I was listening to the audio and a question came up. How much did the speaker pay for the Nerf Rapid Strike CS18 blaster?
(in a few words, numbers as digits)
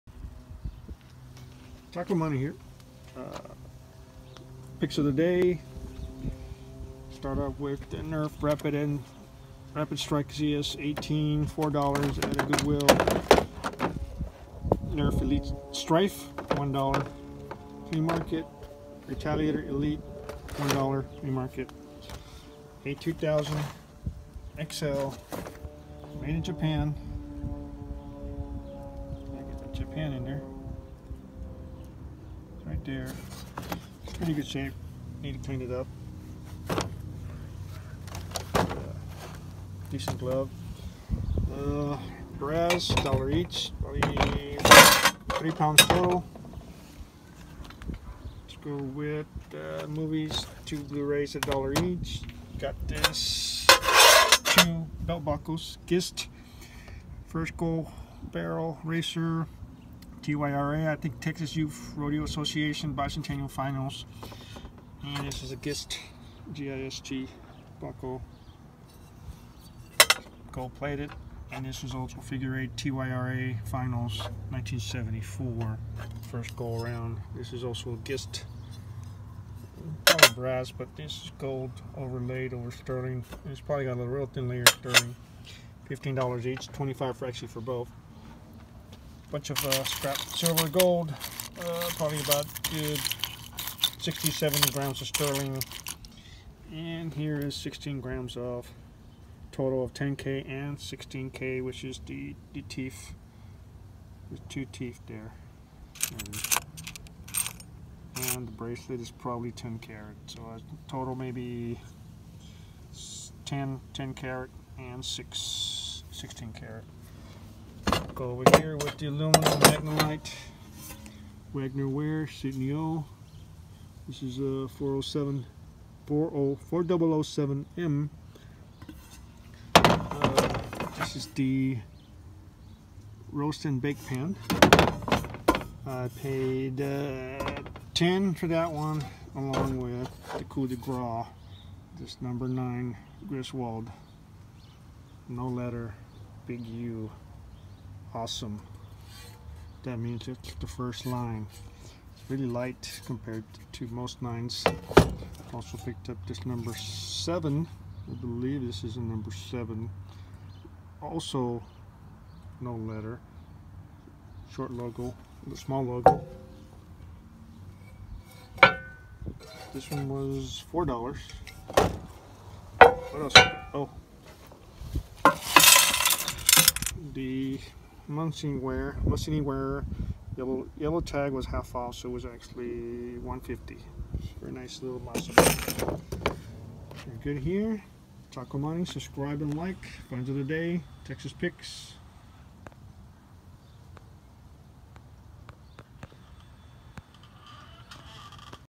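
$4.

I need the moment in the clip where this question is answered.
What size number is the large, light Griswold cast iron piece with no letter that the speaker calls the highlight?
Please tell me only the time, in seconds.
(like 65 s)
142 s.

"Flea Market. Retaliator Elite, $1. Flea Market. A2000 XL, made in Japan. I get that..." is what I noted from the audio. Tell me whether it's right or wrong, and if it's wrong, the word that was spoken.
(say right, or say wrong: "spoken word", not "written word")
right.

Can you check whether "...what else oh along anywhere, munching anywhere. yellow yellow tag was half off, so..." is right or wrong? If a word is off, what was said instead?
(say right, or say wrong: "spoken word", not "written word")
wrong: "munching", not "along".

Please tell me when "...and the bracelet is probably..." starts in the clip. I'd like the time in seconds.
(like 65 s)
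108 s.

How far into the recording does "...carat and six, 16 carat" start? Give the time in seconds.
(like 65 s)
114 s.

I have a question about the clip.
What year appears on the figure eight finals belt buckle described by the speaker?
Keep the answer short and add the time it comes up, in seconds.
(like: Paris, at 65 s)
1974, at 74 s.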